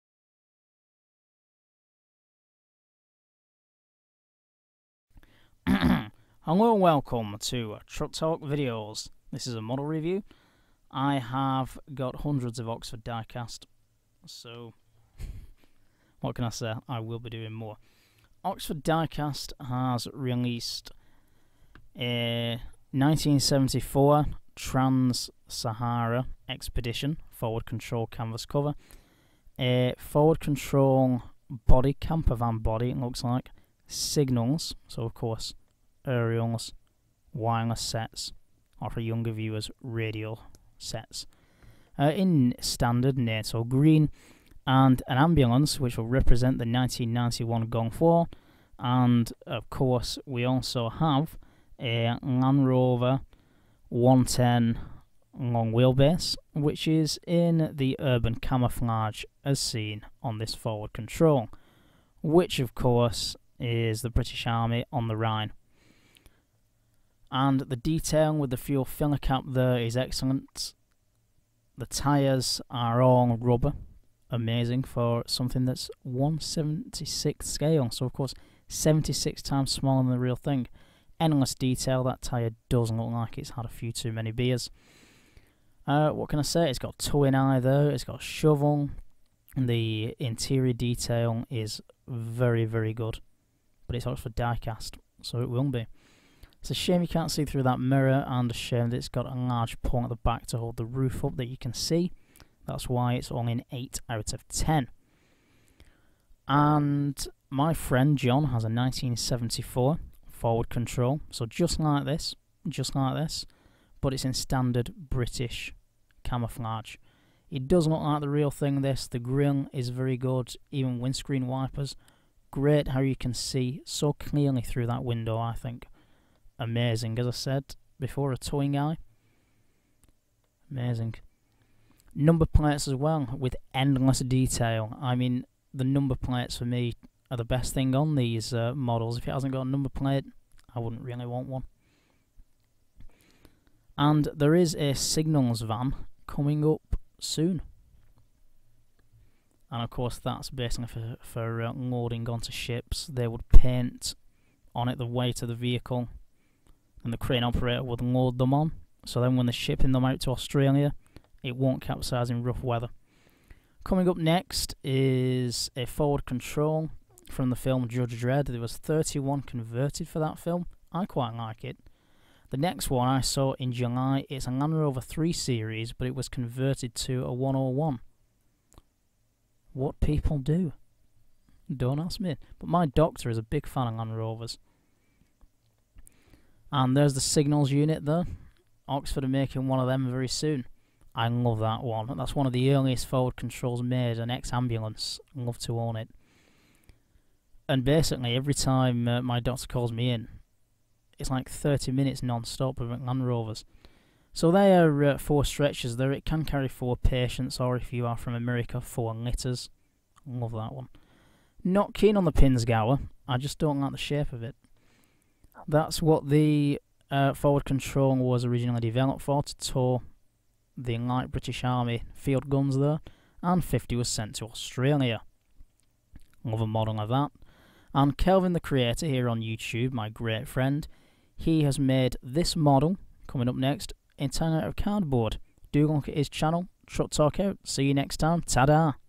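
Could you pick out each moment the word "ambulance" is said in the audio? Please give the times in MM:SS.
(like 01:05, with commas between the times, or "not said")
00:45, 03:14.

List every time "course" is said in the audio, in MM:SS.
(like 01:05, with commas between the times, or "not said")
00:35, 00:49, 01:02, 01:18, 02:29.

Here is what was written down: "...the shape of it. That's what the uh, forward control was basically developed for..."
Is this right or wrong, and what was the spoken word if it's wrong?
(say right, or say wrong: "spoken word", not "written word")
wrong: "originally", not "basically".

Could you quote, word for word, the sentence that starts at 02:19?
If it hasn't got a number plate, I wouldn't really want one.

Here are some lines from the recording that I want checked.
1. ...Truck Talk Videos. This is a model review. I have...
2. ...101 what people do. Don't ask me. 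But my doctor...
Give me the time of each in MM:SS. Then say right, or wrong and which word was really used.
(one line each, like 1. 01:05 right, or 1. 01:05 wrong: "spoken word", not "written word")
1. 00:07 right
2. 02:57 right.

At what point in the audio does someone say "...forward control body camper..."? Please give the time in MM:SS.
00:29.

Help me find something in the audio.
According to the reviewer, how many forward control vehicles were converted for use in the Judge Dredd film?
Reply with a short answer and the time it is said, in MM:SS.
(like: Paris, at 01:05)
31, at 02:48.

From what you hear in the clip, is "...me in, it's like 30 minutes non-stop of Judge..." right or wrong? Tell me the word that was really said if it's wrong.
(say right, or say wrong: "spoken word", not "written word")
wrong: "Land", not "Judge".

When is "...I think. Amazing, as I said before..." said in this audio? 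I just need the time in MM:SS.
02:05.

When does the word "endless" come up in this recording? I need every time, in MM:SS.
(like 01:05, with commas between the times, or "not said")
01:21, 02:13.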